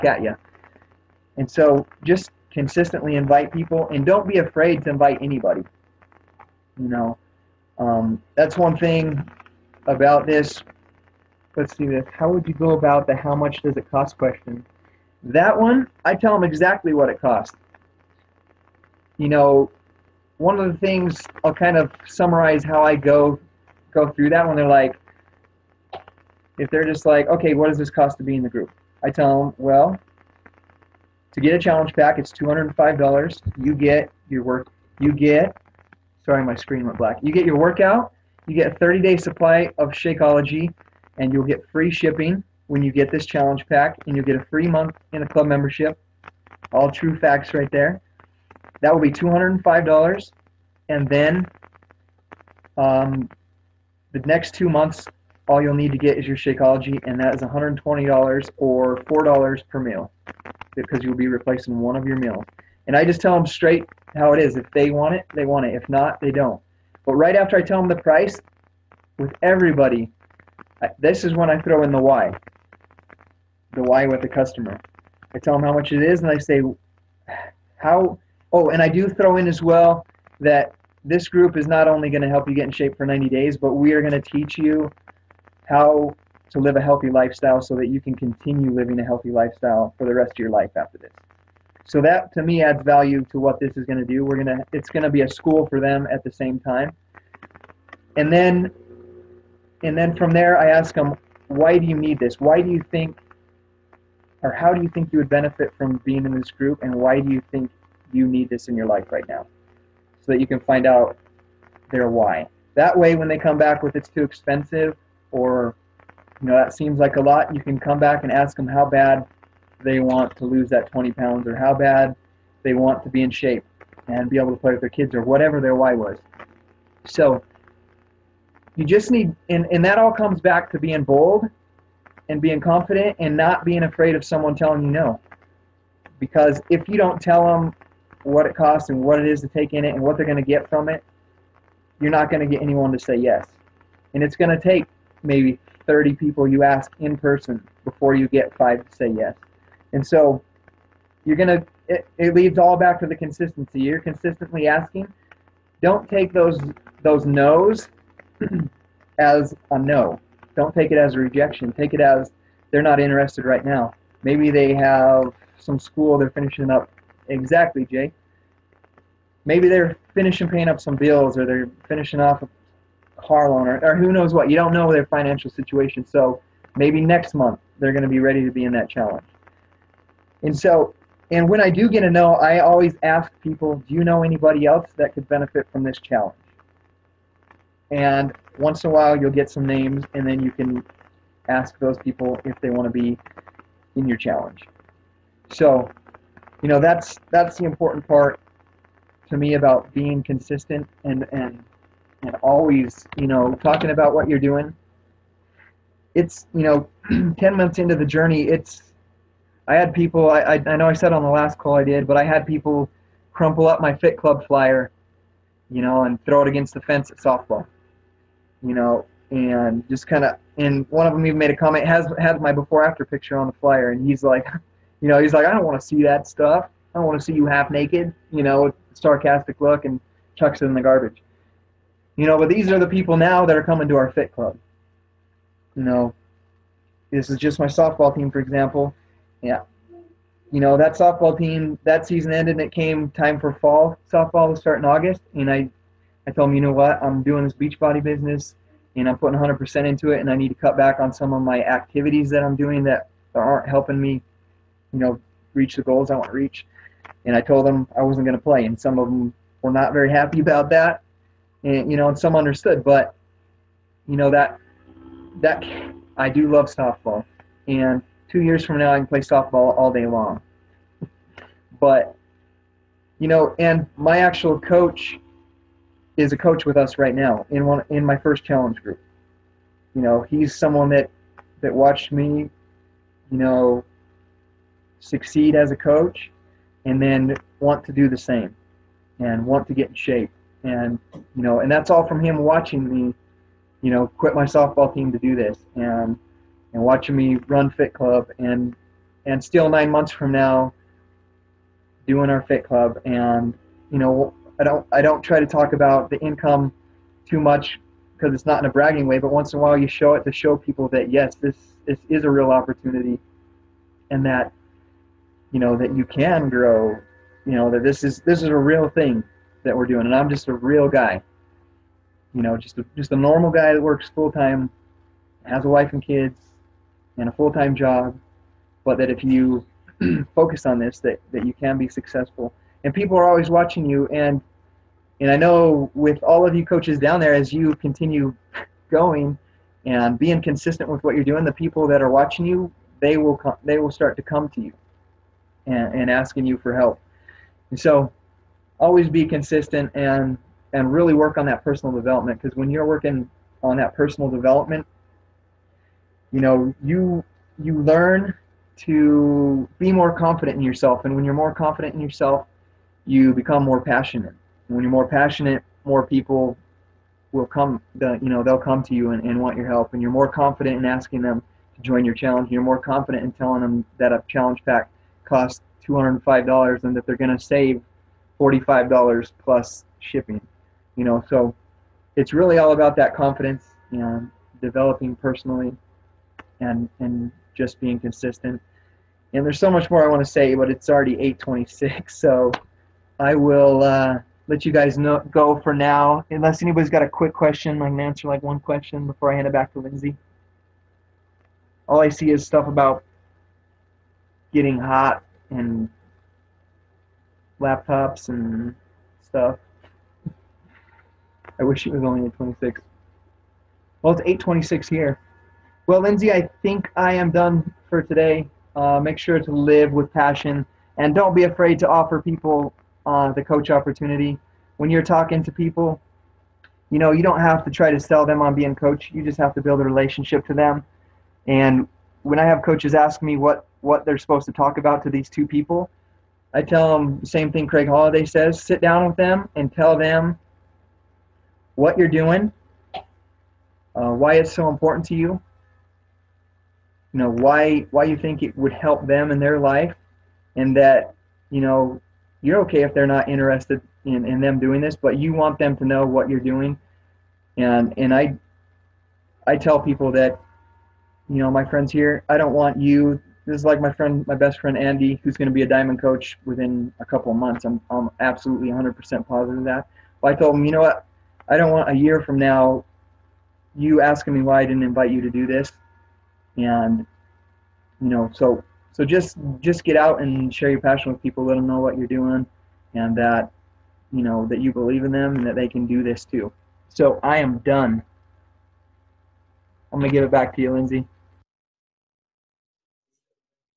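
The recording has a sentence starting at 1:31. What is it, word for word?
So that to me adds value to what this is going to do.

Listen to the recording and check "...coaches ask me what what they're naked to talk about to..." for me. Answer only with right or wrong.
wrong.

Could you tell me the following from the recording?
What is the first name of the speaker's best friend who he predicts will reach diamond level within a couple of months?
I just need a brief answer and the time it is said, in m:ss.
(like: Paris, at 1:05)
Andy, at 7:44.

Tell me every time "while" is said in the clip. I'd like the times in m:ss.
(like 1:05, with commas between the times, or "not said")
3:08, 5:09.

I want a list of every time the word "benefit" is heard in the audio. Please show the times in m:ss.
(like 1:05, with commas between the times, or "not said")
1:45, 3:05.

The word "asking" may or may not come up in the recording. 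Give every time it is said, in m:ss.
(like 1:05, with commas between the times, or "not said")
2:34, 5:46, 6:10, 7:54.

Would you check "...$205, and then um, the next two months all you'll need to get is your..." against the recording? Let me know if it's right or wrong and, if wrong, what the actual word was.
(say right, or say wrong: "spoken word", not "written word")
right.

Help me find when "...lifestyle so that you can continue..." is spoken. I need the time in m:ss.
1:27.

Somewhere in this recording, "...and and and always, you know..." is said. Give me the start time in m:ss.
3:21.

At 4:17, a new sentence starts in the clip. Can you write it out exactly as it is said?
And I told them I wasn't going to play.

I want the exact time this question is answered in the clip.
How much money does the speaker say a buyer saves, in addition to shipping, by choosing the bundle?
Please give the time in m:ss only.
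6:18.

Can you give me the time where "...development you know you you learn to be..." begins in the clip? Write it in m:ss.
5:54.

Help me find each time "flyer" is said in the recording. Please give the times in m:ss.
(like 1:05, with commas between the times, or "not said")
3:34, 3:43.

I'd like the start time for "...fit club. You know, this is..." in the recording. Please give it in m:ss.
3:54.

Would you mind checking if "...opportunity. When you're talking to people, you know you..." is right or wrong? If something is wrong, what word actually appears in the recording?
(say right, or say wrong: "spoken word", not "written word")
right.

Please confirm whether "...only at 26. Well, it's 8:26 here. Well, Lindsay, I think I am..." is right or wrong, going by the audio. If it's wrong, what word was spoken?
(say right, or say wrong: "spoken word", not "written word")
right.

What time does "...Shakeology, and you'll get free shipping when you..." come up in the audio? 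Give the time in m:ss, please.
0:39.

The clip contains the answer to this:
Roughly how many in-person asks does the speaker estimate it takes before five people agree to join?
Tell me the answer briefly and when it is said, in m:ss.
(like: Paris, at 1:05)
30, at 2:25.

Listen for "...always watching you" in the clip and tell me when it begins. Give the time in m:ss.
5:33.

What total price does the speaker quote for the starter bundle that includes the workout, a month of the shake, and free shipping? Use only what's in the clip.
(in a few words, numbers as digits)
$205.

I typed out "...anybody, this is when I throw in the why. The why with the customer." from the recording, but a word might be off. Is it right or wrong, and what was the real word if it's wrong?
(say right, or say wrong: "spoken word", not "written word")
wrong: "everybody", not "anybody".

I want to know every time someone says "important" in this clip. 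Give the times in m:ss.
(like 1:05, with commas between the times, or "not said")
3:17, 7:24.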